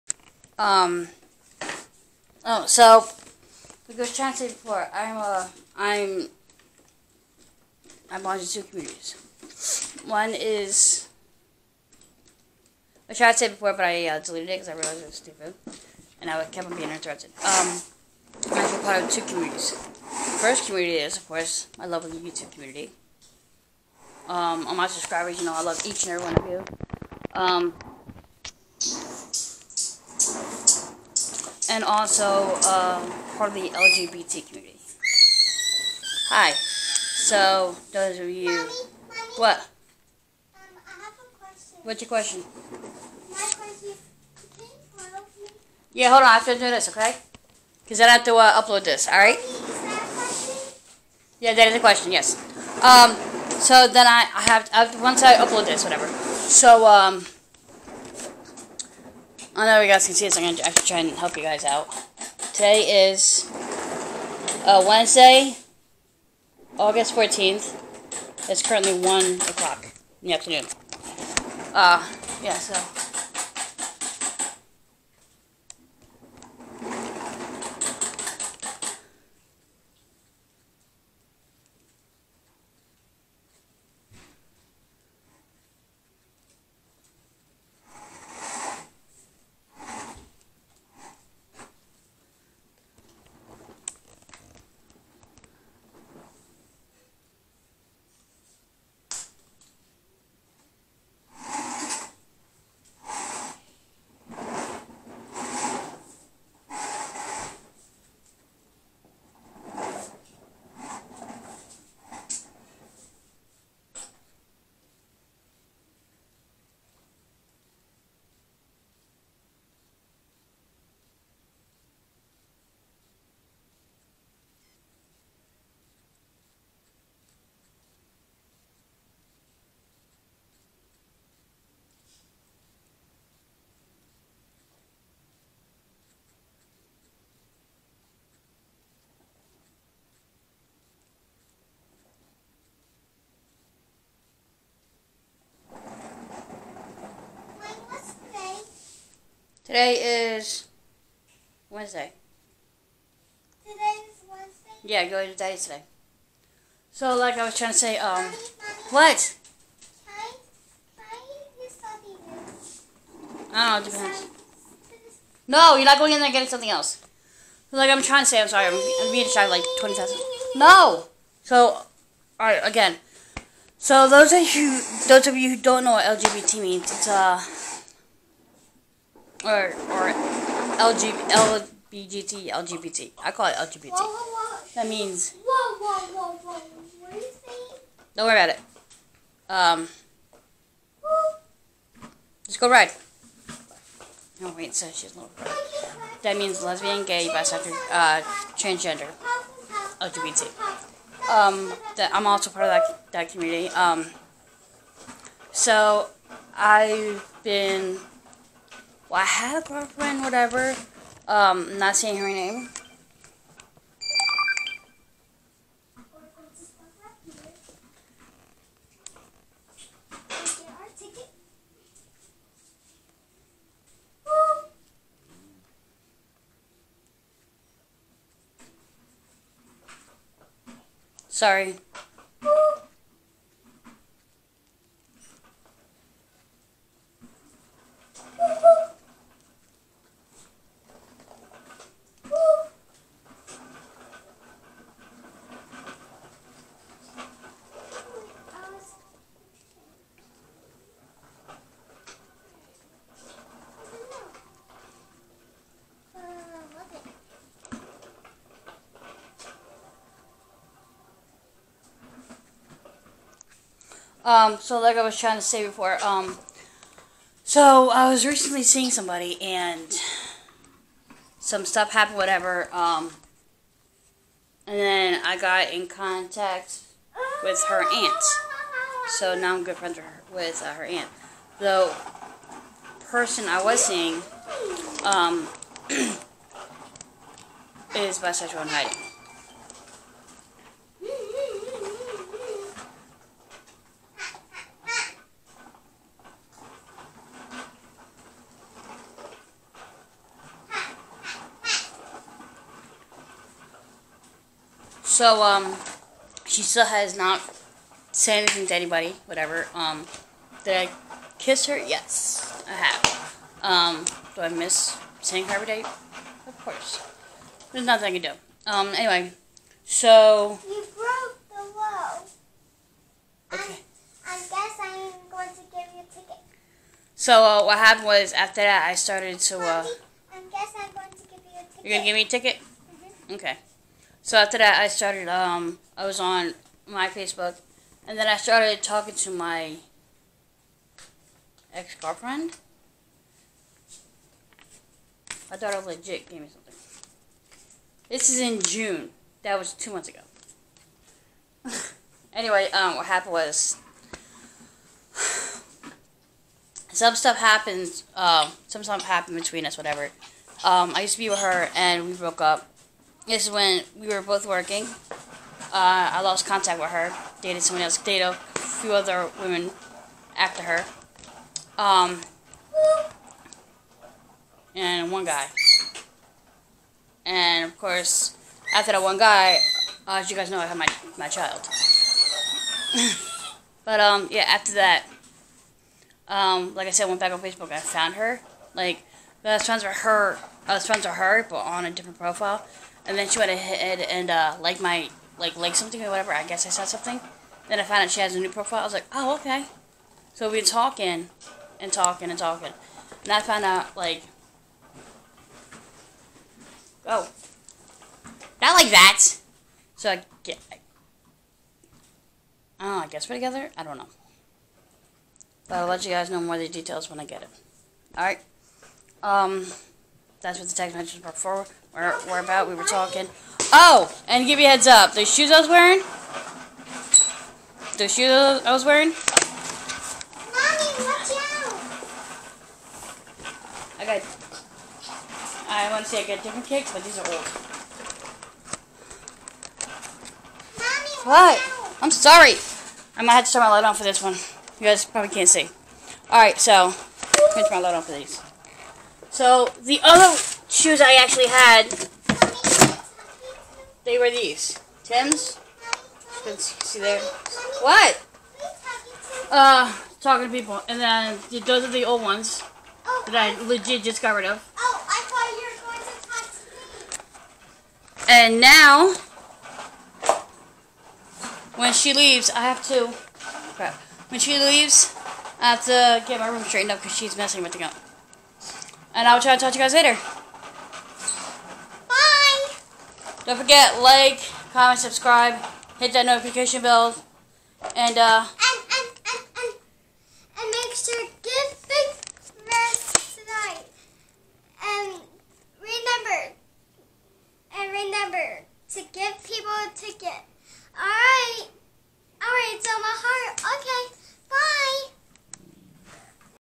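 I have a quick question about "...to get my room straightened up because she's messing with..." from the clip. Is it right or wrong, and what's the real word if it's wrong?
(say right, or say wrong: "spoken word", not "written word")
right.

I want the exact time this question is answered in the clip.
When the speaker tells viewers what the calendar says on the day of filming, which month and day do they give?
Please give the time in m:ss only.
1:06.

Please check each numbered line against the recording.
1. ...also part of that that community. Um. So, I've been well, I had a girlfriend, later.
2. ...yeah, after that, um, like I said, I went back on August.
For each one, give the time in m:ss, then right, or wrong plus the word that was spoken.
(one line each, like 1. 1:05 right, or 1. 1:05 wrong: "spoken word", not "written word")
1. 3:22 wrong: "whatever", not "later"
2. 6:24 wrong: "Facebook", not "August".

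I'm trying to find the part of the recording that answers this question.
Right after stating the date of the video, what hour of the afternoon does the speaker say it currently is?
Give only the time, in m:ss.
1:08.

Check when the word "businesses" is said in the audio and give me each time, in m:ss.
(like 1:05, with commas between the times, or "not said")
not said.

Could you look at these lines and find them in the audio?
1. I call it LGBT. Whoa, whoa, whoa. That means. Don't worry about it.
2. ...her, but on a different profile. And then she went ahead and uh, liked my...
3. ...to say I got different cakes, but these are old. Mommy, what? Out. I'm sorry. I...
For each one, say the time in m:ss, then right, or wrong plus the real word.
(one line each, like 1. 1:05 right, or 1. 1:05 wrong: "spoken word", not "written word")
1. 3:03 right
2. 6:31 right
3. 7:16 right.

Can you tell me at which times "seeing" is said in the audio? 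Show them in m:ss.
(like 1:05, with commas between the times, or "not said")
4:28, 4:43.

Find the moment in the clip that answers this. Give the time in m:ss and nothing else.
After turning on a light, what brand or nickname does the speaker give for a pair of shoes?
7:35.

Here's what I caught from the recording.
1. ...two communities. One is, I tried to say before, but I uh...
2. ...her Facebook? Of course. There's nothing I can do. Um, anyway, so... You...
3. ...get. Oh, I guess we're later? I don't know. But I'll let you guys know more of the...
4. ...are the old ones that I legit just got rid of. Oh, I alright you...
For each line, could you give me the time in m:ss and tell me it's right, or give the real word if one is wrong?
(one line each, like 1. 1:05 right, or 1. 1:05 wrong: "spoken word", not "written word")
1. 0:08 right
2. 5:15 wrong: "Day", not "Facebook"
3. 6:50 wrong: "together", not "later"
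4. 7:41 wrong: "thought", not "alright".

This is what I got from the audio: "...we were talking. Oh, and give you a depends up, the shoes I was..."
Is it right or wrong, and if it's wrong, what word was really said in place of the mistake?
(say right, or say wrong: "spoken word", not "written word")
wrong: "heads", not "depends".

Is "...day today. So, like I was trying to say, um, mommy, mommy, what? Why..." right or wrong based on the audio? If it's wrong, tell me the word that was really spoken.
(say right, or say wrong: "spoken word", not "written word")
right.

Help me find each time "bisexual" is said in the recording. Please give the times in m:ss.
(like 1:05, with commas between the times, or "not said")
3:17, 4:48.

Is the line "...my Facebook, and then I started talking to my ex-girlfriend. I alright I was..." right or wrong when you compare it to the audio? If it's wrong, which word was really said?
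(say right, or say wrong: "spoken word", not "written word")
wrong: "thought", not "alright".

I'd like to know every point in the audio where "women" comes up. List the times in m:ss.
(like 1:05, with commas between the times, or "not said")
6:09.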